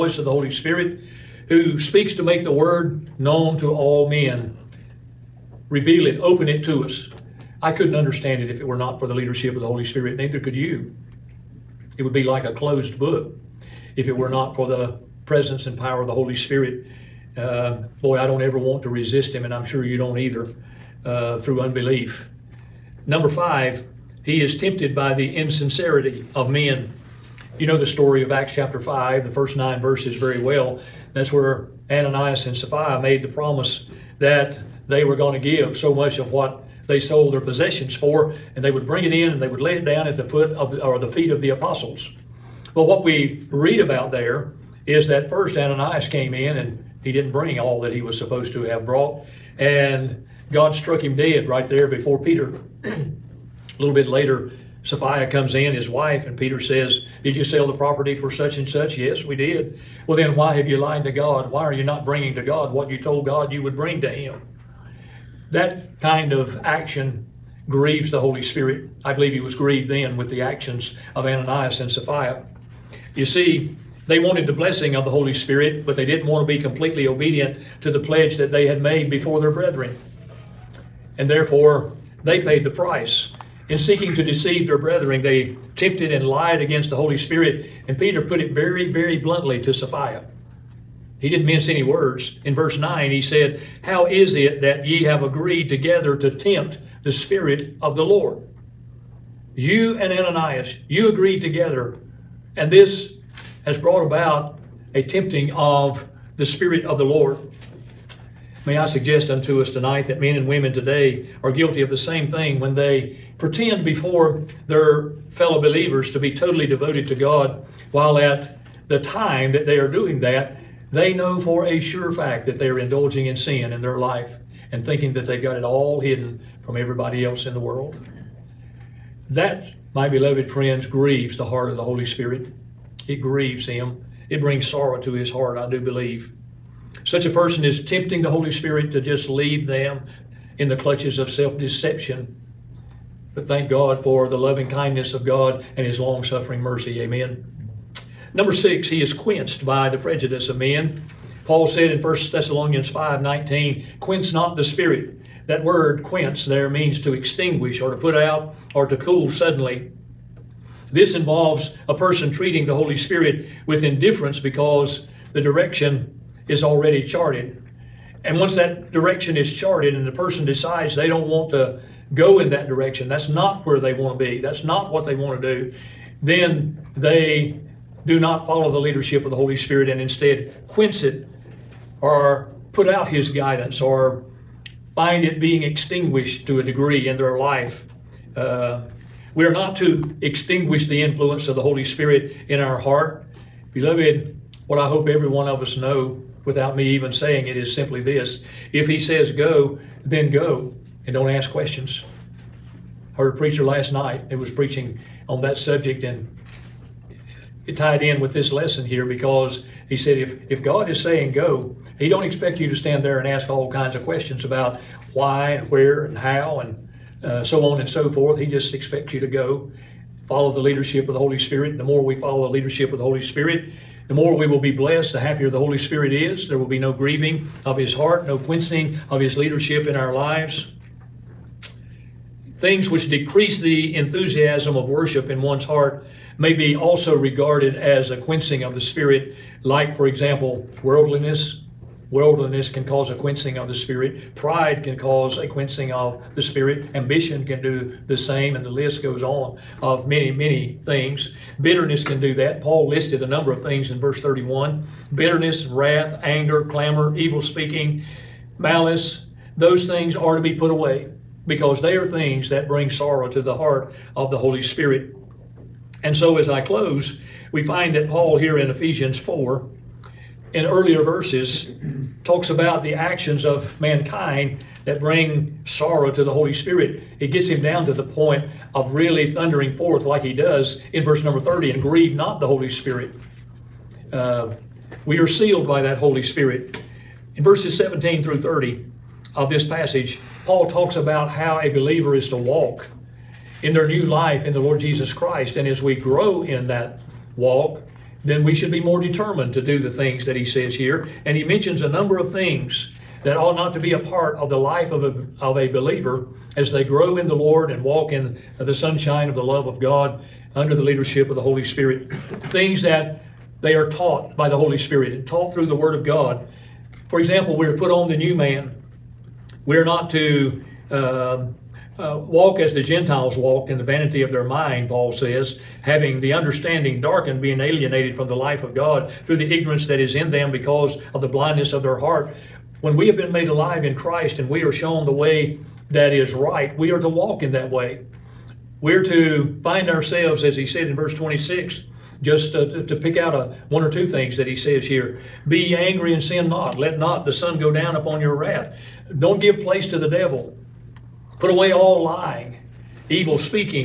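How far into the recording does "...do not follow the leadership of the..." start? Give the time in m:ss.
2:58.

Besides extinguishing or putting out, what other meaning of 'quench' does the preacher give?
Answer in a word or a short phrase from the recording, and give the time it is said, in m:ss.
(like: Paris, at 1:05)
To cool suddenly, at 2:38.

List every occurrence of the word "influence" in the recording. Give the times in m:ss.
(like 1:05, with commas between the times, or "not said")
3:11.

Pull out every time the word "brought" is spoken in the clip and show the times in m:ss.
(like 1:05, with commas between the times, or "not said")
0:48, 1:43.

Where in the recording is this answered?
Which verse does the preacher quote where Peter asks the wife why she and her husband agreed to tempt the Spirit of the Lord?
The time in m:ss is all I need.
1:32.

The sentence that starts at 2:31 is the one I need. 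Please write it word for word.
Paul said in 1 Thessalonians 5 19, quench not the spirit.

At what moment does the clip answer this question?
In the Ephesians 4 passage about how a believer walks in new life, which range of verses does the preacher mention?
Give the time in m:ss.
4:47.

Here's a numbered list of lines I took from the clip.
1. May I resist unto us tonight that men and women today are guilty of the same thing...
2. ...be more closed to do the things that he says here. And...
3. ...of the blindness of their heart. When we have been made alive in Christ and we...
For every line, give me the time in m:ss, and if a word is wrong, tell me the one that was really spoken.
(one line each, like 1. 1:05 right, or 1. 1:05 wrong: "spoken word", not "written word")
1. 1:48 wrong: "suggest", not "resist"
2. 4:58 wrong: "determined", not "closed"
3. 5:31 right.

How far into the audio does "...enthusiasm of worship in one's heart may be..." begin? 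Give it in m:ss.
3:53.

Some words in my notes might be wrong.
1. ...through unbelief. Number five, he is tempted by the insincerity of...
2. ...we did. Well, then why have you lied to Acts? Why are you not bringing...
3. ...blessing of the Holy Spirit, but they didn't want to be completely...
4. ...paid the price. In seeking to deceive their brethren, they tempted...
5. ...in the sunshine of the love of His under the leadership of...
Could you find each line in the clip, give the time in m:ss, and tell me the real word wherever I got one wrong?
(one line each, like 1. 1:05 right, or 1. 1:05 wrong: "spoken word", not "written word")
1. 0:21 right
2. 0:59 wrong: "God", not "Acts"
3. 1:14 right
4. 1:22 right
5. 5:08 wrong: "God", not "His".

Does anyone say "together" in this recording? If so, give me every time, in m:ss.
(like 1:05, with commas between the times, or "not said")
1:35, 1:41.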